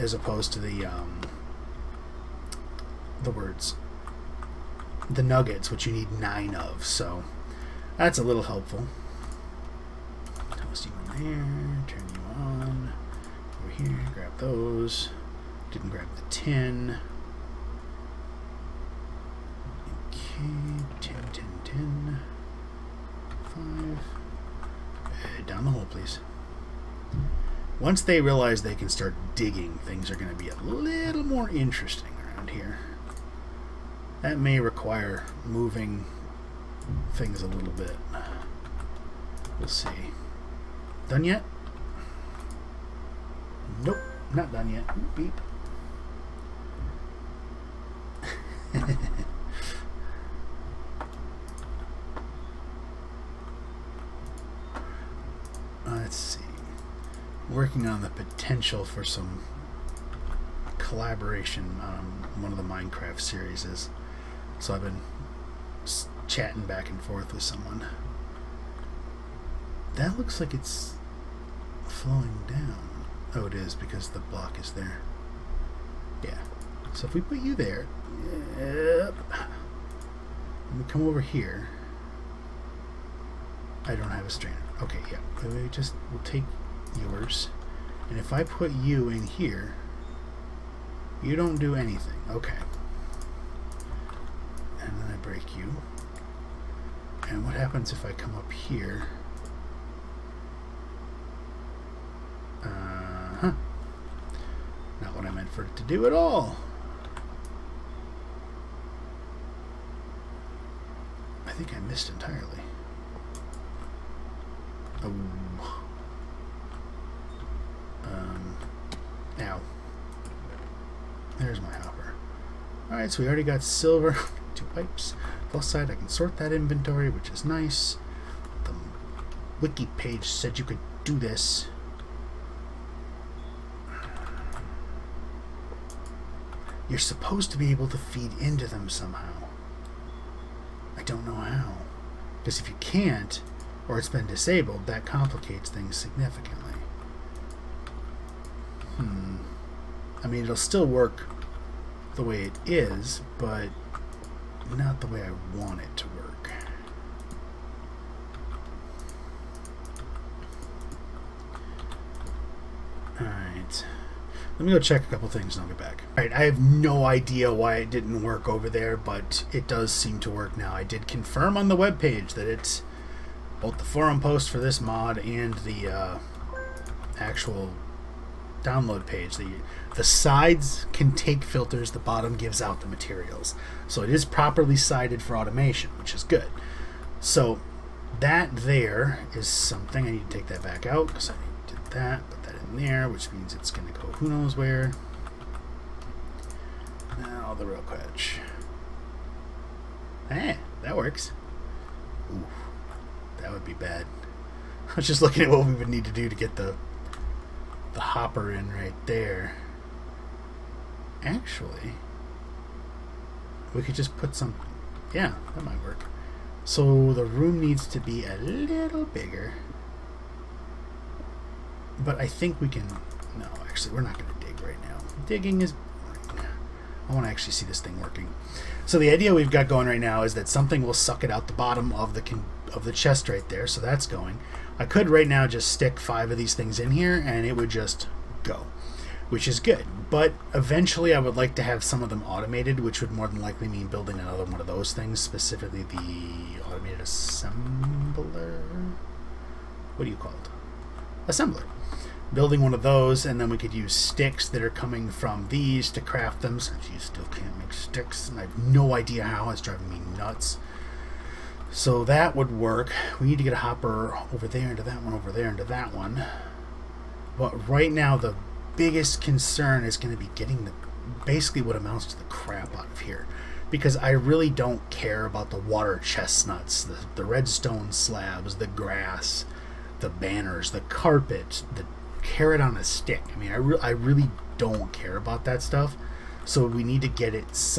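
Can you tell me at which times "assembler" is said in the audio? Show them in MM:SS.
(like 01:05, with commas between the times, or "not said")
04:06, 04:11.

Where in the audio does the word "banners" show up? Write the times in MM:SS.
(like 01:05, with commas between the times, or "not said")
04:40.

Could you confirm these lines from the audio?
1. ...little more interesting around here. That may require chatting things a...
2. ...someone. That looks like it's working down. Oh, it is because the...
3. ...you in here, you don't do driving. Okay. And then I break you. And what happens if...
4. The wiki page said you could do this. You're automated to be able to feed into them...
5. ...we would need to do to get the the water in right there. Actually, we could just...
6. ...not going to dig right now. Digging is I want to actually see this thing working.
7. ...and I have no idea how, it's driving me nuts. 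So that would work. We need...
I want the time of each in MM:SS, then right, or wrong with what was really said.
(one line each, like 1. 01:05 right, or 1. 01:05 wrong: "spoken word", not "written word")
1. 00:30 wrong: "moving", not "chatting"
2. 01:07 wrong: "flowing", not "working"
3. 01:28 wrong: "anything", not "driving"
4. 02:08 wrong: "supposed", not "automated"
5. 03:25 wrong: "hopper", not "water"
6. 03:44 right
7. 04:18 right.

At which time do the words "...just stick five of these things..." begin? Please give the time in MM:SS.
03:55.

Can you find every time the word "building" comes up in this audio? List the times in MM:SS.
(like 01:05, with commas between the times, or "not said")
04:03, 04:12.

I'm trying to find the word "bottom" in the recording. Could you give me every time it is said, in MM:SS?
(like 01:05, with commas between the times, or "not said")
03:01, 03:51.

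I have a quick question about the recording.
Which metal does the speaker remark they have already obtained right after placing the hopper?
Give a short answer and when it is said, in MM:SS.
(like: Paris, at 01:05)
Silver, at 02:03.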